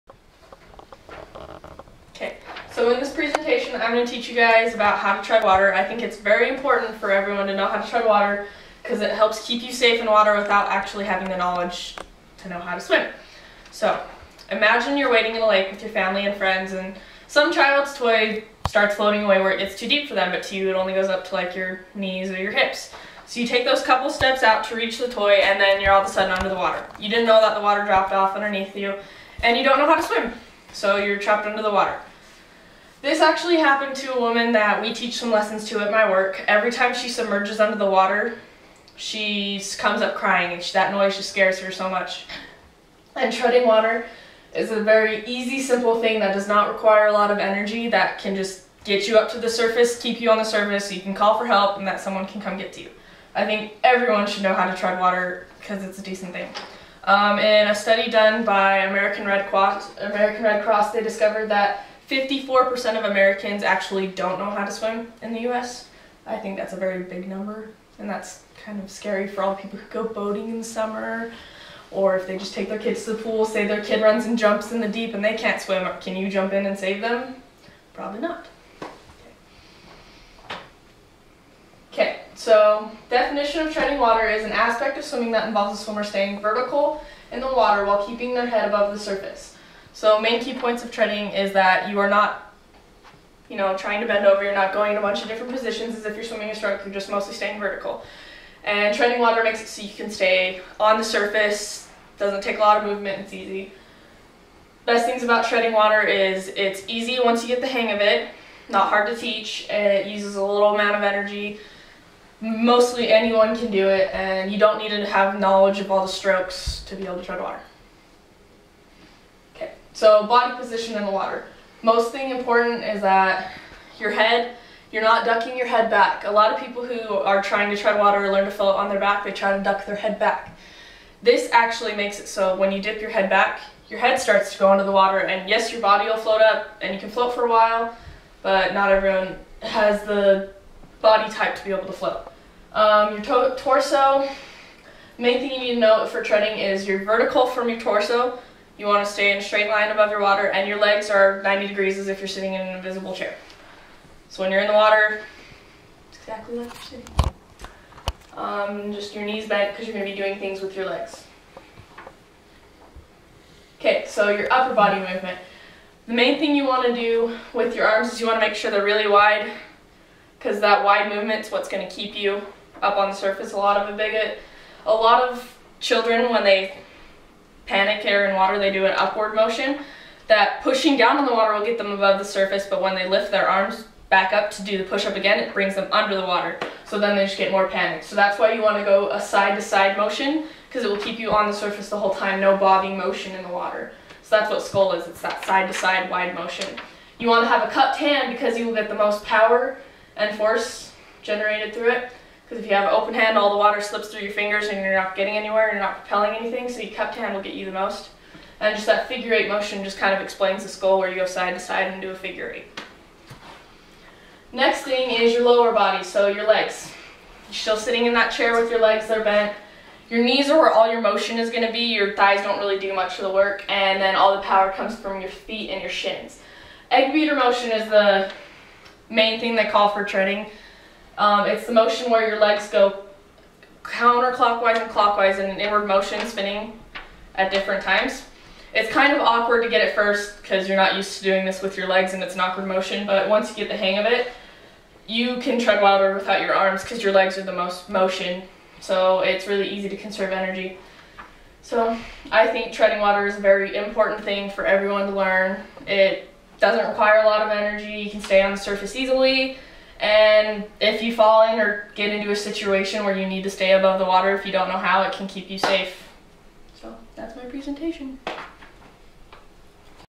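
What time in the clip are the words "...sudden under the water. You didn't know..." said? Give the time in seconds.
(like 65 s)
26 s.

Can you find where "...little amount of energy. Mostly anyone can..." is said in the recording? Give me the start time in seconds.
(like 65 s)
110 s.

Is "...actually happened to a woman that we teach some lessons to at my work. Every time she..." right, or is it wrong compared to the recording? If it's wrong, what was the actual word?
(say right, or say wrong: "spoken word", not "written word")
right.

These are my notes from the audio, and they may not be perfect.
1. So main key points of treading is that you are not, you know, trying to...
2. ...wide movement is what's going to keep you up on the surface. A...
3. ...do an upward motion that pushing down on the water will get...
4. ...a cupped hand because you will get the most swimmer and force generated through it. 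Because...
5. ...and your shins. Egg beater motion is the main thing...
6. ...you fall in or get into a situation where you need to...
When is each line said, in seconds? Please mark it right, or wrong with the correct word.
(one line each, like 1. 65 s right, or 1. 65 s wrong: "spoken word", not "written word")
1. 89 s right
2. 170 s right
3. 178 s right
4. 197 s wrong: "power", not "swimmer"
5. 225 s right
6. 261 s right.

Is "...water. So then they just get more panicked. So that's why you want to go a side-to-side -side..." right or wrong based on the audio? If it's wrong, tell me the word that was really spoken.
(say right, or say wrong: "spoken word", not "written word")
right.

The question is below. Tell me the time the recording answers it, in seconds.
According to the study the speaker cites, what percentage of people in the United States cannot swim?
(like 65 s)
62 s.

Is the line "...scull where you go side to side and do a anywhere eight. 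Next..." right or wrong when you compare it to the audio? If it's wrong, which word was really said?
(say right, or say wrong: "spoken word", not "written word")
wrong: "figure", not "anywhere".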